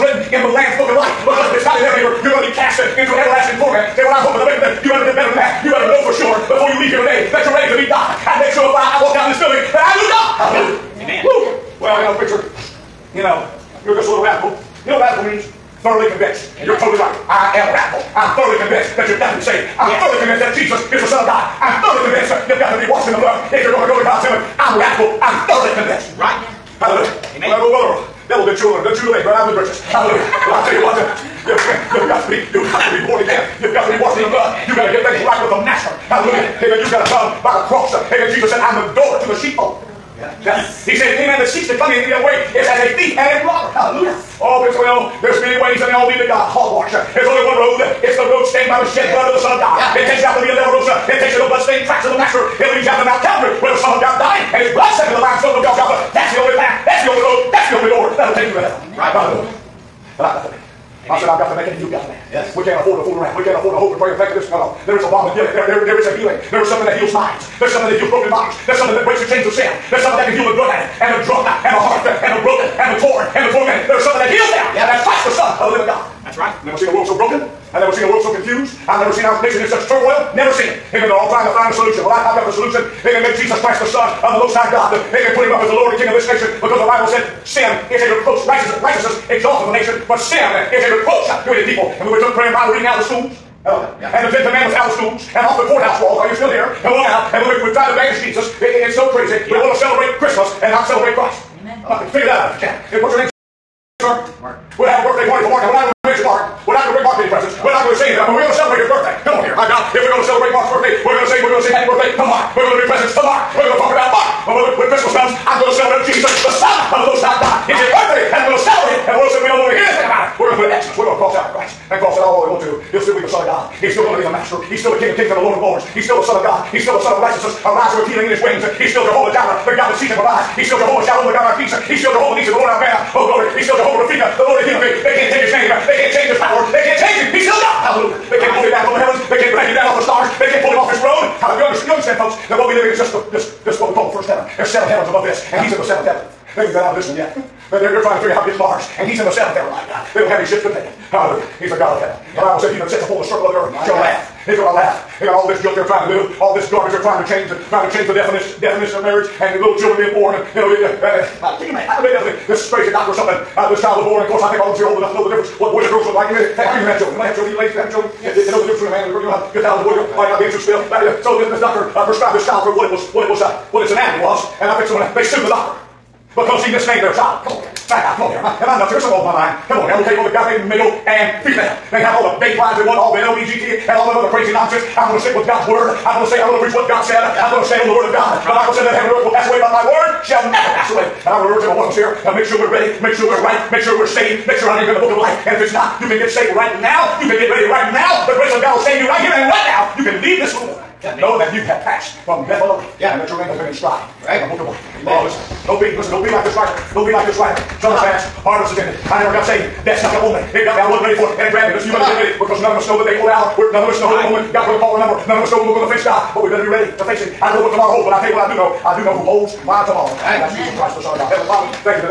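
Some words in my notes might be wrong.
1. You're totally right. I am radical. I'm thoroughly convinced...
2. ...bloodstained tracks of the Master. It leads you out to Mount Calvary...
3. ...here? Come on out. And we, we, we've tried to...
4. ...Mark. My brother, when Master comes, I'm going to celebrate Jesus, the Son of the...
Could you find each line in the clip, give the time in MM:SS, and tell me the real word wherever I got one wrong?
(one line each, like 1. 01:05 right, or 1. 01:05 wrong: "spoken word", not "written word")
1. 00:16 right
2. 00:51 right
3. 01:36 right
4. 01:54 wrong: "Christmas", not "Master".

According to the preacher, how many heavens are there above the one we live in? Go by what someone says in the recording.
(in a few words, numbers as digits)
7.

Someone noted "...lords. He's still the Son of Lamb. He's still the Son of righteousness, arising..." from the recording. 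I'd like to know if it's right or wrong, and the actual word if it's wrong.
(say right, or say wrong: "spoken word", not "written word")
wrong: "God", not "Lamb".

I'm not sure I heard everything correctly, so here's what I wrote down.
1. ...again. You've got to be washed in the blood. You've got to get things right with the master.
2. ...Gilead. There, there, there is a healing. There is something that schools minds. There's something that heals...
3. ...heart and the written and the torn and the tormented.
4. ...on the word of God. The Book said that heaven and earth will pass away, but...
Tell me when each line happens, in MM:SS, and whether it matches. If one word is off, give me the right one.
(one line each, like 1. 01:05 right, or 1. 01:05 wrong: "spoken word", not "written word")
1. 00:33 right
2. 01:05 wrong: "heals", not "schools"
3. 01:11 wrong: "broken", not "written"
4. 03:07 wrong: "Bible", not "Book".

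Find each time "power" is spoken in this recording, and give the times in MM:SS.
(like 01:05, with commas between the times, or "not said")
02:16.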